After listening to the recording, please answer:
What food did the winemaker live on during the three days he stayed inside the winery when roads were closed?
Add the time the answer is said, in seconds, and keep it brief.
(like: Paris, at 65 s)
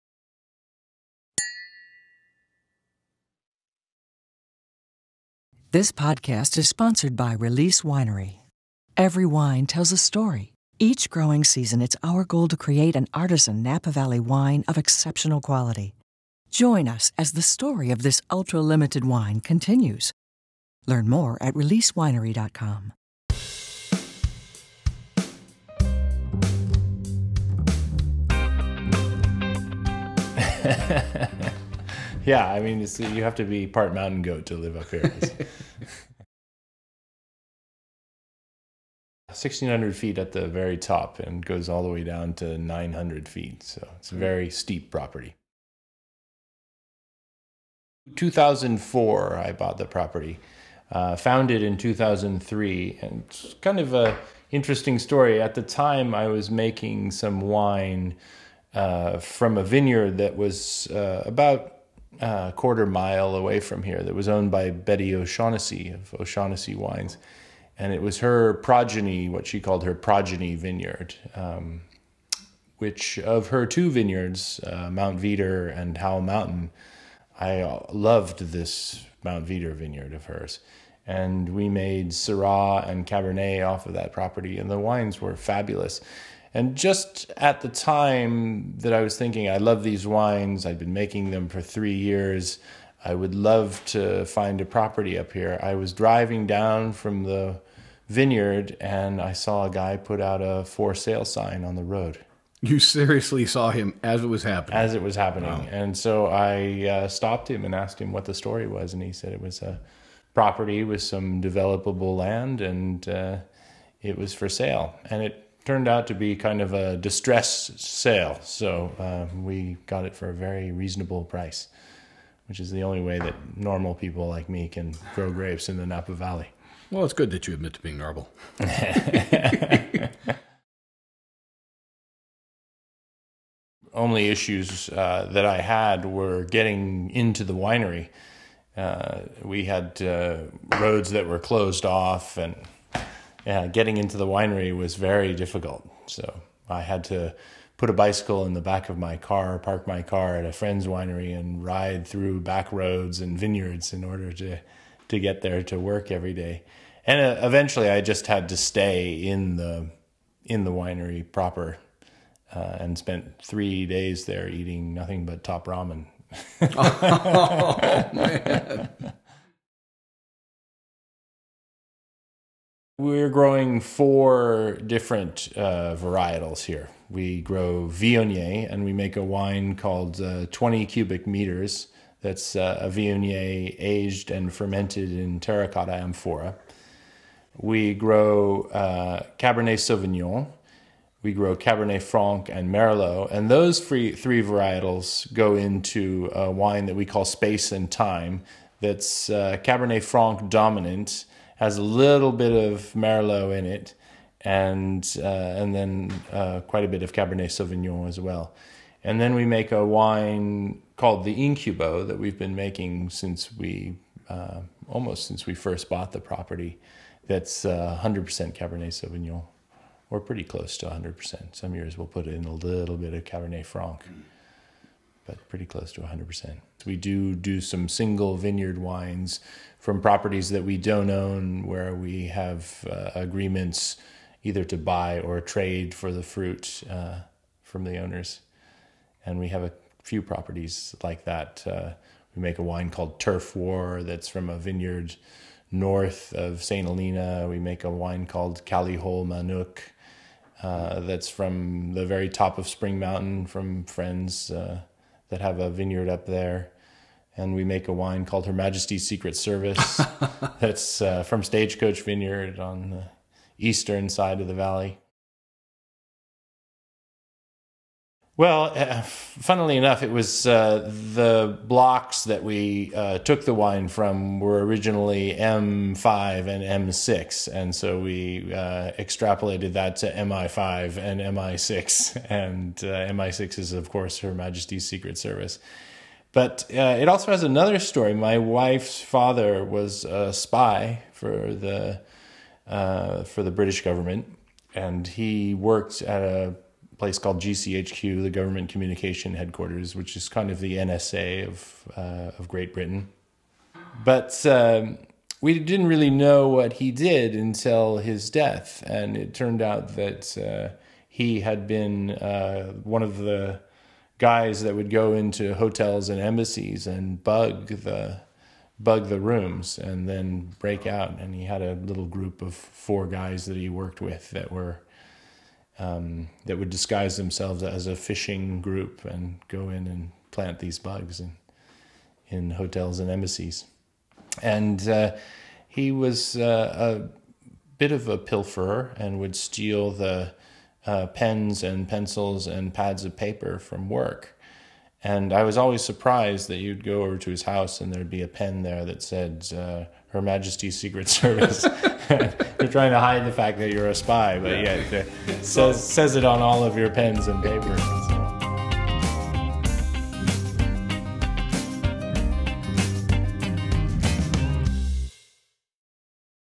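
Top ramen, at 165 s.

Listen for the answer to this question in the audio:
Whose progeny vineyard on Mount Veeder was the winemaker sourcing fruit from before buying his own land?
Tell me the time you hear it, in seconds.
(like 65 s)
64 s.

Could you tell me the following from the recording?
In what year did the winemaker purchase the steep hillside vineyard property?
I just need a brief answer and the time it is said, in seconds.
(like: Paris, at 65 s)
2004, at 48 s.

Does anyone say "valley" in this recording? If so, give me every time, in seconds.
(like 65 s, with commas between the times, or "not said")
13 s, 126 s, 264 s.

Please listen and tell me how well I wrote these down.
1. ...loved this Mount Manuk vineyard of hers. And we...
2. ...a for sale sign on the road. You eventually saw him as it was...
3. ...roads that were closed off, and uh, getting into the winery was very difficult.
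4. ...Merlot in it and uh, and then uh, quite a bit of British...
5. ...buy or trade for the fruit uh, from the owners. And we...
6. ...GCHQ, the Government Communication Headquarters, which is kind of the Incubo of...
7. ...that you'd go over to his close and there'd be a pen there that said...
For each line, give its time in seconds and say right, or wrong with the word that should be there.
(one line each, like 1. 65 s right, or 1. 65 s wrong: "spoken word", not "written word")
1. 77 s wrong: "Veeder", not "Manuk"
2. 100 s wrong: "seriously", not "eventually"
3. 140 s right
4. 202 s wrong: "Cabernet", not "British"
5. 234 s right
6. 297 s wrong: "NSA", not "Incubo"
7. 346 s wrong: "house", not "close".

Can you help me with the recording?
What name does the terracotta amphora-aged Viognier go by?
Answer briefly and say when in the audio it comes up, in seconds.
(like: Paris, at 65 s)
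20 cubic meters, at 180 s.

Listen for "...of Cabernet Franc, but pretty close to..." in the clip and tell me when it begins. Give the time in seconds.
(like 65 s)
223 s.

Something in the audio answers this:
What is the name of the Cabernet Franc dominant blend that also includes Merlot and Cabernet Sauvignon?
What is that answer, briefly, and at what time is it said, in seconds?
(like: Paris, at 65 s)
Space and Time, at 197 s.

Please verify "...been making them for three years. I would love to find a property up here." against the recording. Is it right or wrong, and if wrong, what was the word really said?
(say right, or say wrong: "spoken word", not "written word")
right.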